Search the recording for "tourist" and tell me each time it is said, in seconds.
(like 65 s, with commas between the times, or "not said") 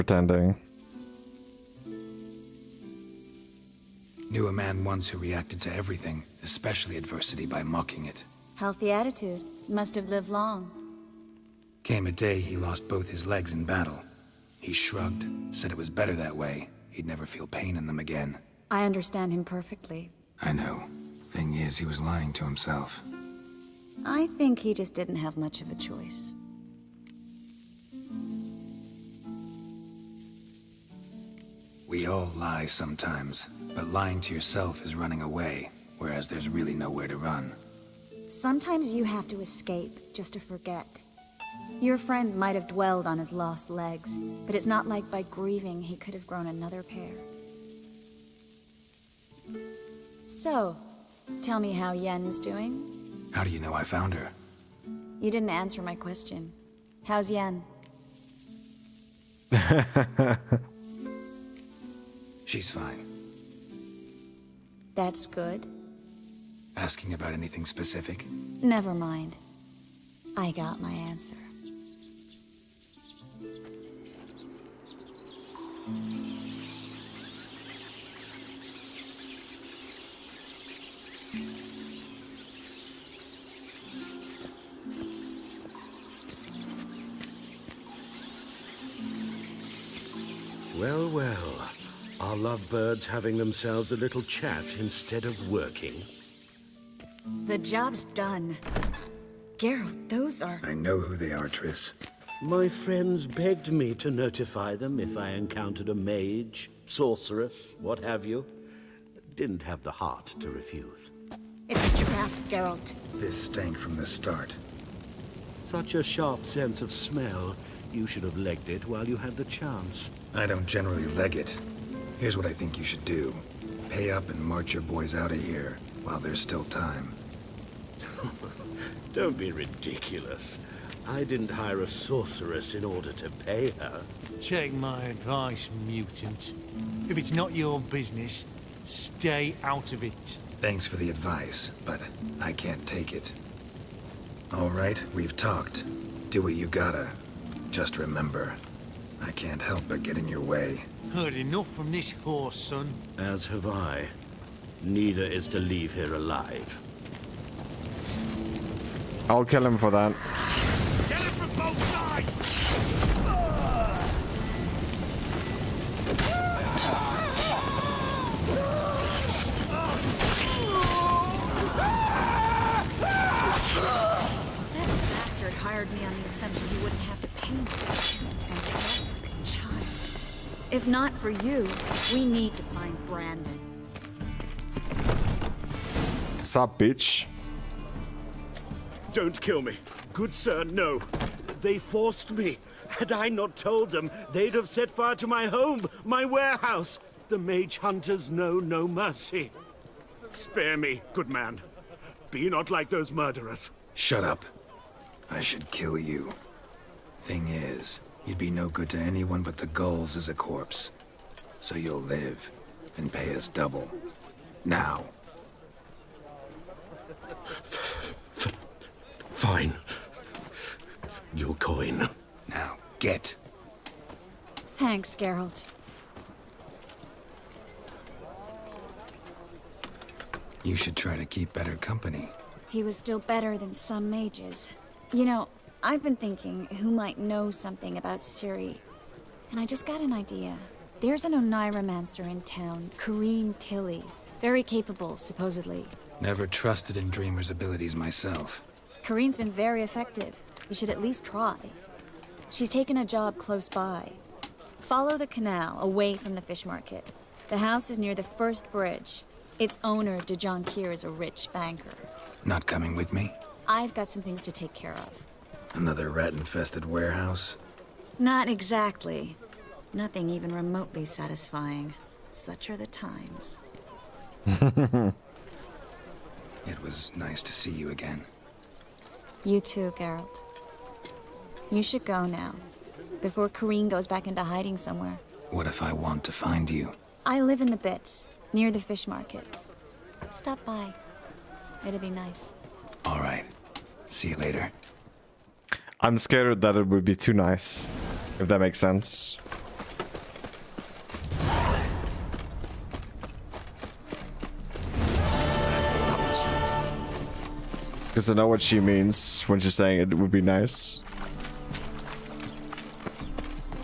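not said.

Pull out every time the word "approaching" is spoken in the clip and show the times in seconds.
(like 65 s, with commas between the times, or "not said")
not said.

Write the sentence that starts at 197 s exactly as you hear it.
The mage hunters know no mercy.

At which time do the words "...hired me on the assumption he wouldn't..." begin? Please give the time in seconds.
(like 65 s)
175 s.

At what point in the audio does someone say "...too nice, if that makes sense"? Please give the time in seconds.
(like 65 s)
297 s.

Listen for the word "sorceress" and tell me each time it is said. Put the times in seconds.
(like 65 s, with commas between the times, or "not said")
106 s, 131 s.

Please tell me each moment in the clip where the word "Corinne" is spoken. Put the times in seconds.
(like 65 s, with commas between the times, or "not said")
242 s, 249 s, 283 s.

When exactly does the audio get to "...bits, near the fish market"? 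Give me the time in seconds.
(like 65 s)
287 s.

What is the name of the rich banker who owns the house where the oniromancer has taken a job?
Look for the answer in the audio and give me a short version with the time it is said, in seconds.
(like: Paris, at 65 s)
DeJonkir, at 260 s.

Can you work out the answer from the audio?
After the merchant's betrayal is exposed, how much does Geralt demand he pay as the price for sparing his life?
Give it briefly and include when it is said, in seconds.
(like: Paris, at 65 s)
Double, at 213 s.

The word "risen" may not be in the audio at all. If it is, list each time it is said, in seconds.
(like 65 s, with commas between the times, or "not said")
not said.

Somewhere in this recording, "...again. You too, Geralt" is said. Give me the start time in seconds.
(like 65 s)
277 s.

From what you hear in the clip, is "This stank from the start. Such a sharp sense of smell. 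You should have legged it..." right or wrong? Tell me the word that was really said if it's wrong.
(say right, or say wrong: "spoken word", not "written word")
right.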